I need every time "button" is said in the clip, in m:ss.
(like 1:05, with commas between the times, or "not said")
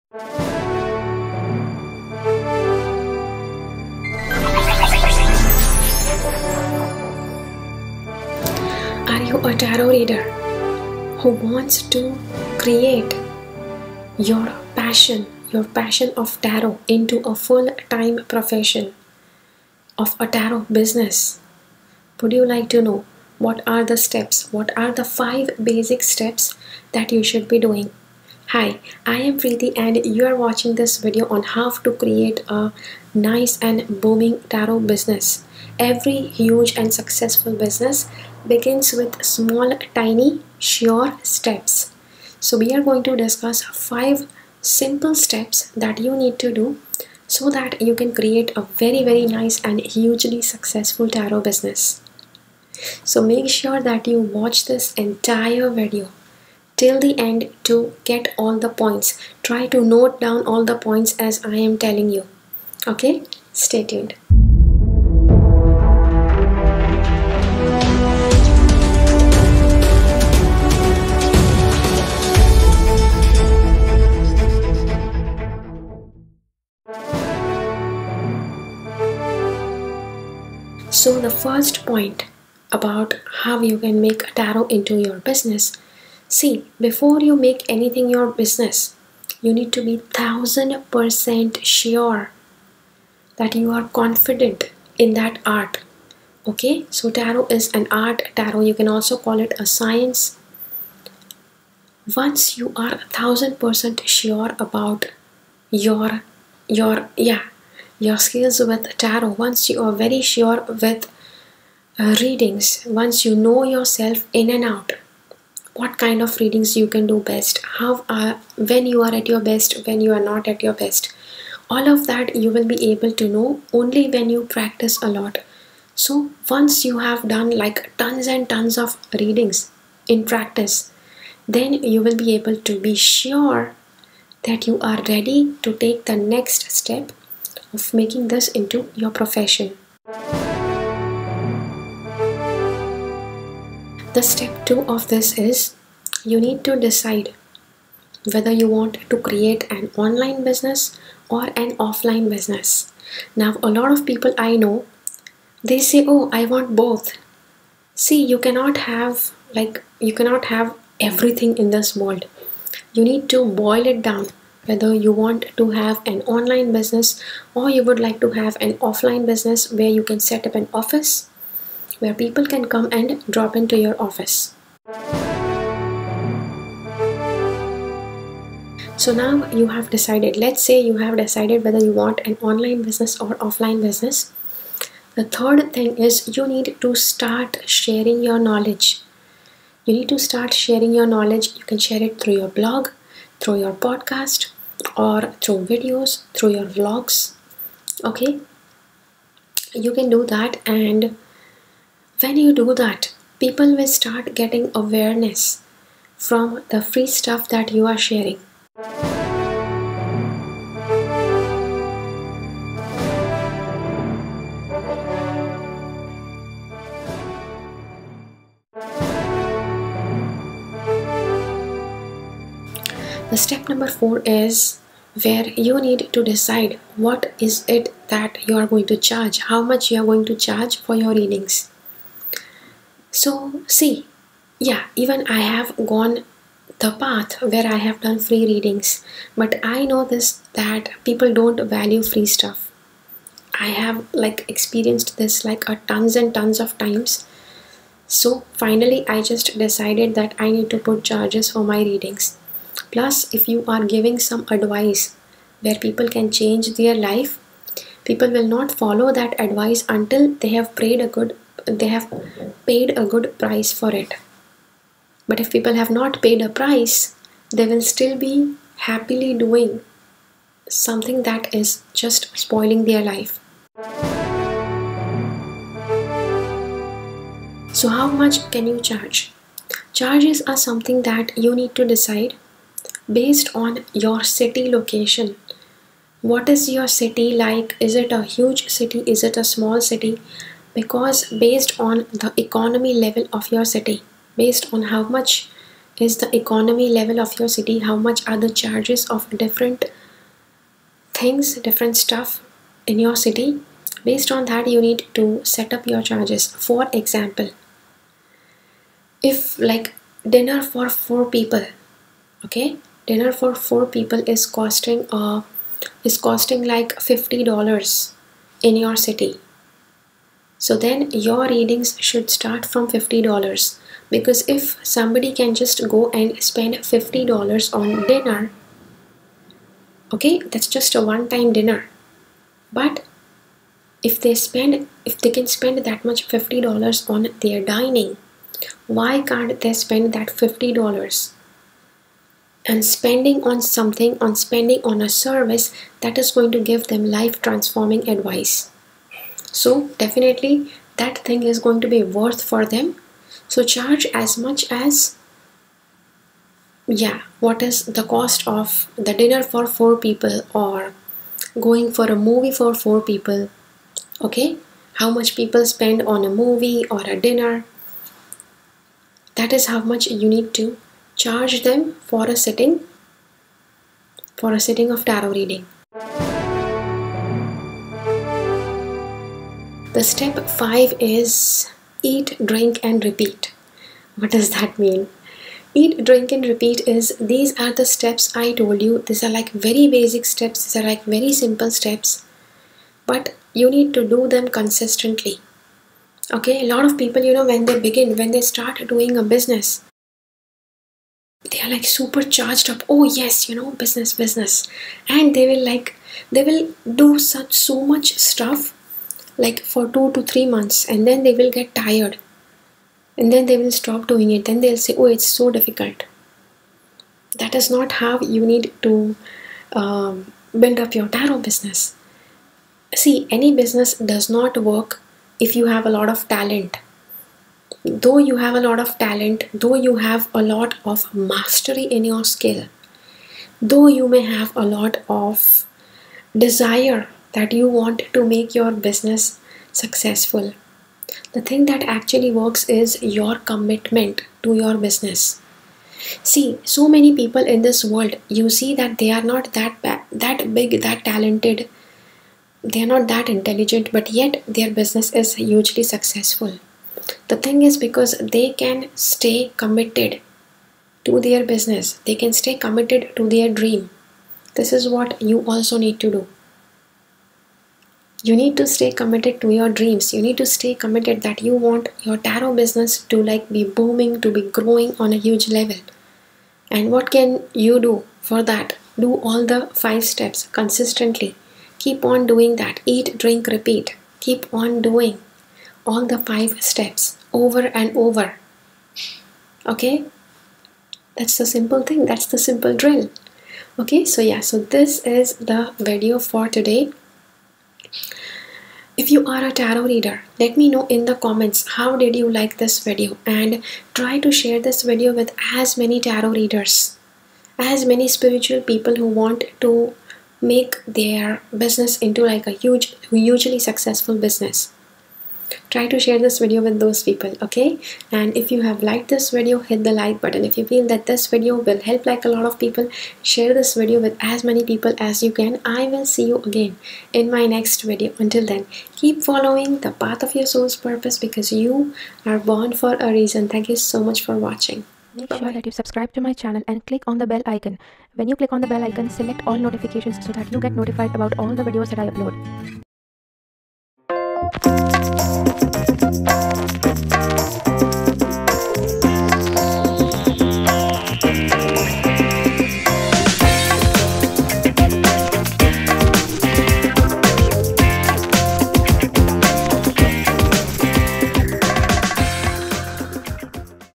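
8:40.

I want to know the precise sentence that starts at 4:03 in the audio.
I have like experienced this like a tons and tons of times.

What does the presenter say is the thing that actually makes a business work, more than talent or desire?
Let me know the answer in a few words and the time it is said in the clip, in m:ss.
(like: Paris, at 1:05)
commitment, at 7:23.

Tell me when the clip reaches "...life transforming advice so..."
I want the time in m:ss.
5:47.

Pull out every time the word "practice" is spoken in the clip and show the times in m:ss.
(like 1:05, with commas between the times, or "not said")
2:04, 2:10.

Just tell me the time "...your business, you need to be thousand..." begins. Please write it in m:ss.
1:28.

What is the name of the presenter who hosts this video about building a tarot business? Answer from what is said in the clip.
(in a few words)
Preeti.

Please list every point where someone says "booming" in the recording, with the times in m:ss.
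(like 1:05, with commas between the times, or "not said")
0:34, 7:53.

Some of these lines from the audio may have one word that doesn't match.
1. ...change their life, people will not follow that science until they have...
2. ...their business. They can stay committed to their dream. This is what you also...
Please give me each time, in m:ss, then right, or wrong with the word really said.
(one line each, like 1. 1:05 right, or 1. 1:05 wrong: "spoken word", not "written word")
1. 4:16 wrong: "advice", not "science"
2. 7:41 right.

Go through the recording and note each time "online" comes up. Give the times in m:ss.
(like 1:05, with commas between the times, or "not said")
2:29, 2:46, 3:02.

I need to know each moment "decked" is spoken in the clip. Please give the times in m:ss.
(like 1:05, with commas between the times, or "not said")
not said.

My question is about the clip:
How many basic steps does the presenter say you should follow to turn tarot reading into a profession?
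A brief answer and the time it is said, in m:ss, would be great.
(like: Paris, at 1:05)
5, at 0:25.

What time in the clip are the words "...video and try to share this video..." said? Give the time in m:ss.
8:22.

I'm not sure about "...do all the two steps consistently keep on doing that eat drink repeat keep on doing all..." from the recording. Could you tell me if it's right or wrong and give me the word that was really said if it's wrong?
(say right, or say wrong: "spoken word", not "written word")
wrong: "five", not "two".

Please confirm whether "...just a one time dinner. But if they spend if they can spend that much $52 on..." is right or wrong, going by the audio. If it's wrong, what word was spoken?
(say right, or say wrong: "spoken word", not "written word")
wrong: "50", not "52".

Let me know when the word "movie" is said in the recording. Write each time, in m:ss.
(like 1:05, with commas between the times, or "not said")
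6:02, 6:06.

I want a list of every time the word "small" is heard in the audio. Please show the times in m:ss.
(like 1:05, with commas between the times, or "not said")
0:39, 4:49.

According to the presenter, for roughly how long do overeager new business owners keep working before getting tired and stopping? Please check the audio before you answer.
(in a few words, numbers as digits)
2 to 3 months.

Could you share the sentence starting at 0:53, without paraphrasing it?
So make sure that you watch this entire video till the end to get all the points.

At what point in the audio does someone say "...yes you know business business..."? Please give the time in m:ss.
6:43.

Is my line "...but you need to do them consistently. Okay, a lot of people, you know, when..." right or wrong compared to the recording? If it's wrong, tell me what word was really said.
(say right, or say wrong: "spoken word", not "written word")
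right.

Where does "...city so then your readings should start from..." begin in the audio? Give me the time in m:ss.
5:18.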